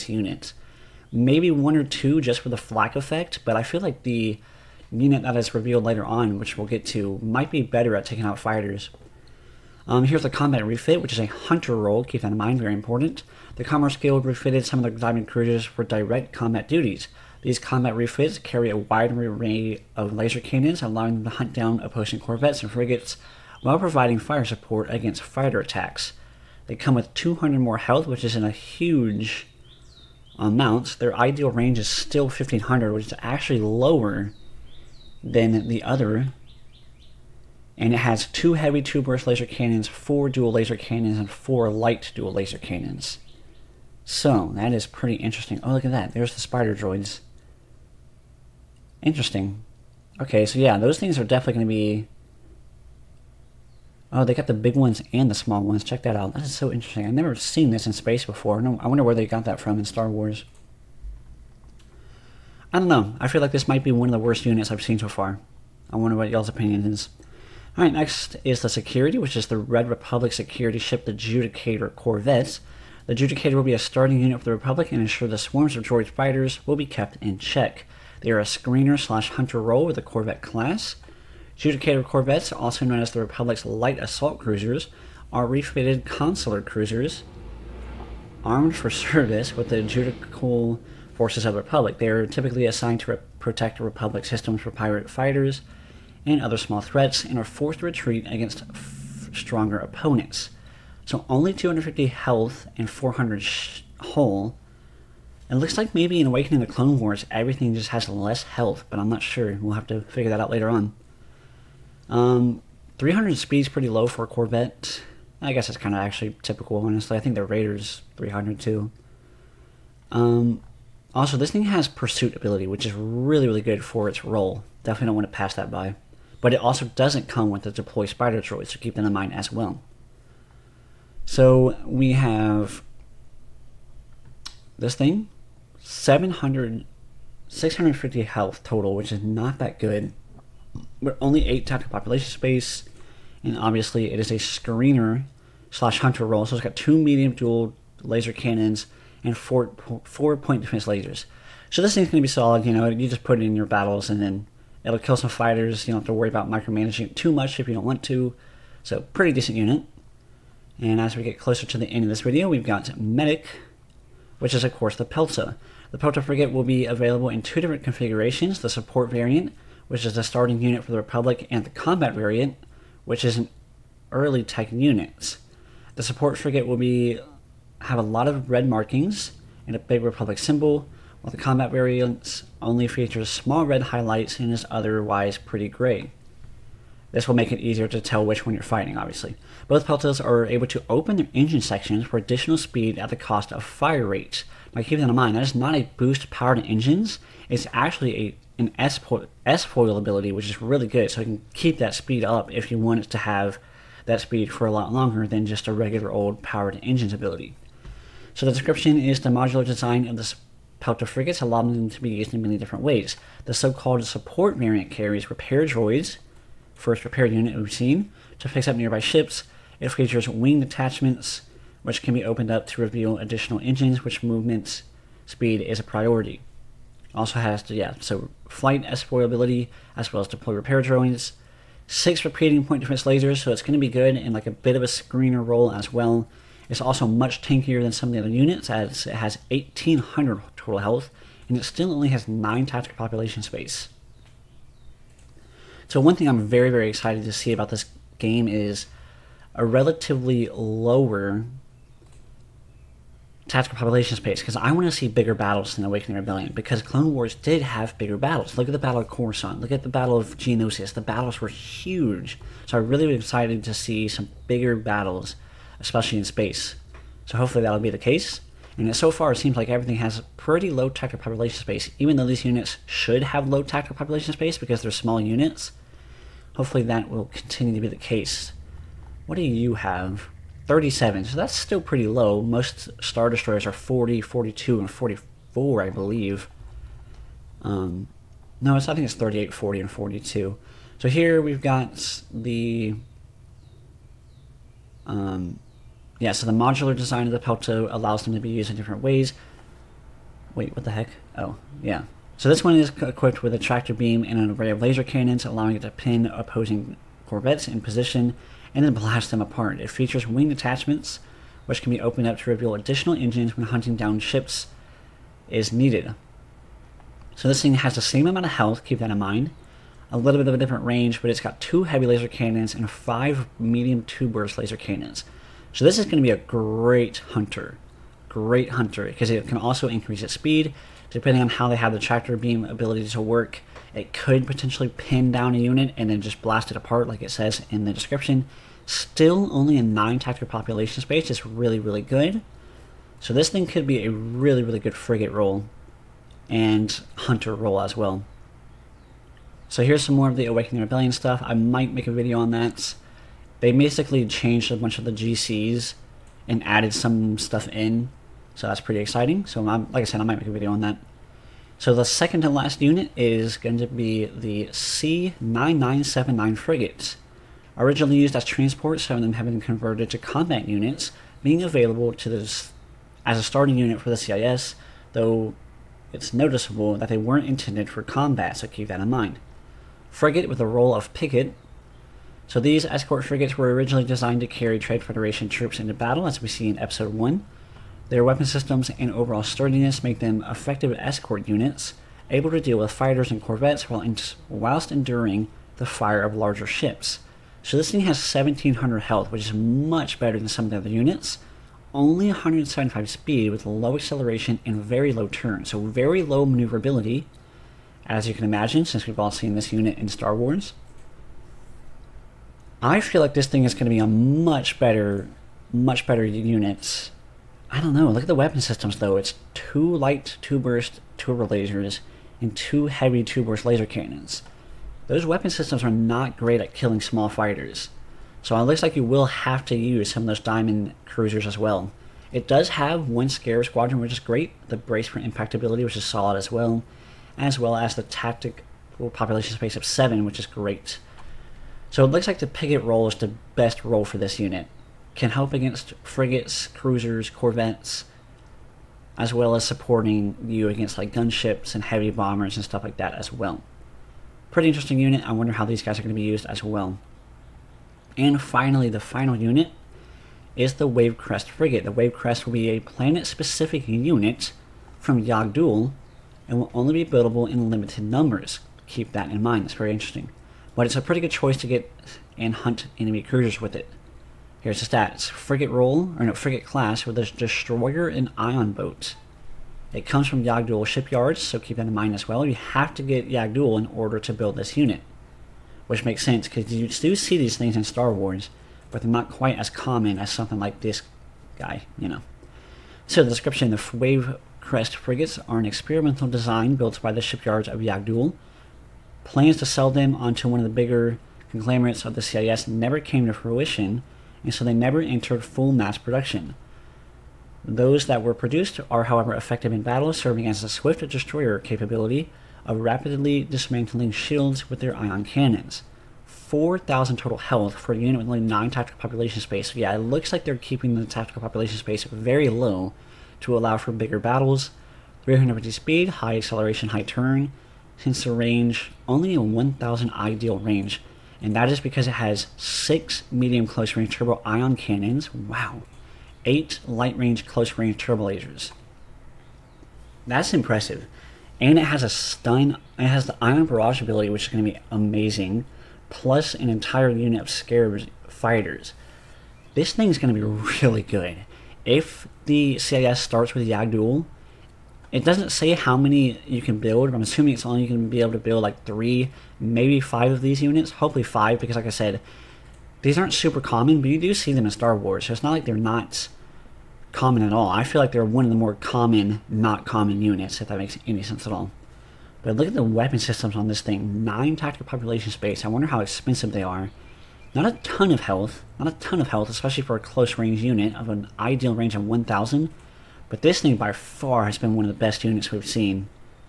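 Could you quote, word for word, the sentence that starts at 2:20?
We're only 8 tactical population space, and obviously it is a screener slash hunter role.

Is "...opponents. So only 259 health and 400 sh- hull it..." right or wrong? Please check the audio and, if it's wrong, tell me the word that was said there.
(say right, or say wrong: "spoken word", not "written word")
wrong: "250", not "259".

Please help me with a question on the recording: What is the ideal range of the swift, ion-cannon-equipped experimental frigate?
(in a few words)
1,000.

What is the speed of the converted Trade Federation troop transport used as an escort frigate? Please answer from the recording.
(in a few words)
175.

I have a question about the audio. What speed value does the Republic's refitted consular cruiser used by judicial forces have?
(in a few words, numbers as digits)
300.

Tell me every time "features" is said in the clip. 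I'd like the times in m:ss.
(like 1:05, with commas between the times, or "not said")
3:02, 3:39, 5:09.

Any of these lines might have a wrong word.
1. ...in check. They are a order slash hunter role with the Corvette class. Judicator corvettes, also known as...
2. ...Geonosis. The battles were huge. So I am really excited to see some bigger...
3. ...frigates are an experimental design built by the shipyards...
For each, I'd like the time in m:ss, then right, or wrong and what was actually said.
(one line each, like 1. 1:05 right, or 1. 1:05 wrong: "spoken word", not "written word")
1. 1:17 wrong: "screener", not "order"
2. 4:20 right
3. 8:14 right.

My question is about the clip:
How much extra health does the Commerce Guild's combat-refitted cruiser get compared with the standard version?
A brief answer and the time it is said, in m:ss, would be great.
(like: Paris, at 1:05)
200, at 0:27.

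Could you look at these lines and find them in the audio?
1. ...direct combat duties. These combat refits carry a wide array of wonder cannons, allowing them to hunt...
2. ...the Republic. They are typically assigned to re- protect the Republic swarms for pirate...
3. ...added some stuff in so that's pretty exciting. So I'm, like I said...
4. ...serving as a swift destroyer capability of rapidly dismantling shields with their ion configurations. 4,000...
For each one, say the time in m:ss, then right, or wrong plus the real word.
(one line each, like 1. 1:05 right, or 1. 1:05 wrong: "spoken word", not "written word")
1. 0:15 wrong: "laser", not "wonder"
2. 1:31 wrong: "systems", not "swarms"
3. 5:56 right
4. 8:30 wrong: "cannons", not "configurations".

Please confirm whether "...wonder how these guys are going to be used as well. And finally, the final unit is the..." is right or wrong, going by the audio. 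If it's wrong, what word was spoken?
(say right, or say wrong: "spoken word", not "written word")
right.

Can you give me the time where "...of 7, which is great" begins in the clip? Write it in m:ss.
7:19.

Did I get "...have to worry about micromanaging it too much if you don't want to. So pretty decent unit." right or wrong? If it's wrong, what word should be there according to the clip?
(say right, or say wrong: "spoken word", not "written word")
right.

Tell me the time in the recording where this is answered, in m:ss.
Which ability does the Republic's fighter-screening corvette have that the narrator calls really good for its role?
2:01.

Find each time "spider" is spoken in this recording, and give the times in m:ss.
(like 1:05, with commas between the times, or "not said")
0:46, 2:08.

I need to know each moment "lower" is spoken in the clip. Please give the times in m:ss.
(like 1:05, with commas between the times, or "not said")
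0:33, 4:10.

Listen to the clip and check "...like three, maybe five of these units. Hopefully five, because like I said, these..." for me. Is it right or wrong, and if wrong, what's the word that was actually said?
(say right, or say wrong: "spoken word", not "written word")
right.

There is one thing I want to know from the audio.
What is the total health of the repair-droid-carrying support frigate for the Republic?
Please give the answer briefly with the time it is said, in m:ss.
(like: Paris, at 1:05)
1800, at 3:59.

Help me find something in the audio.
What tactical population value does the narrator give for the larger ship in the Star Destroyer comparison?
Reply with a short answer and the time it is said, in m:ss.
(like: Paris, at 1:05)
37, at 4:40.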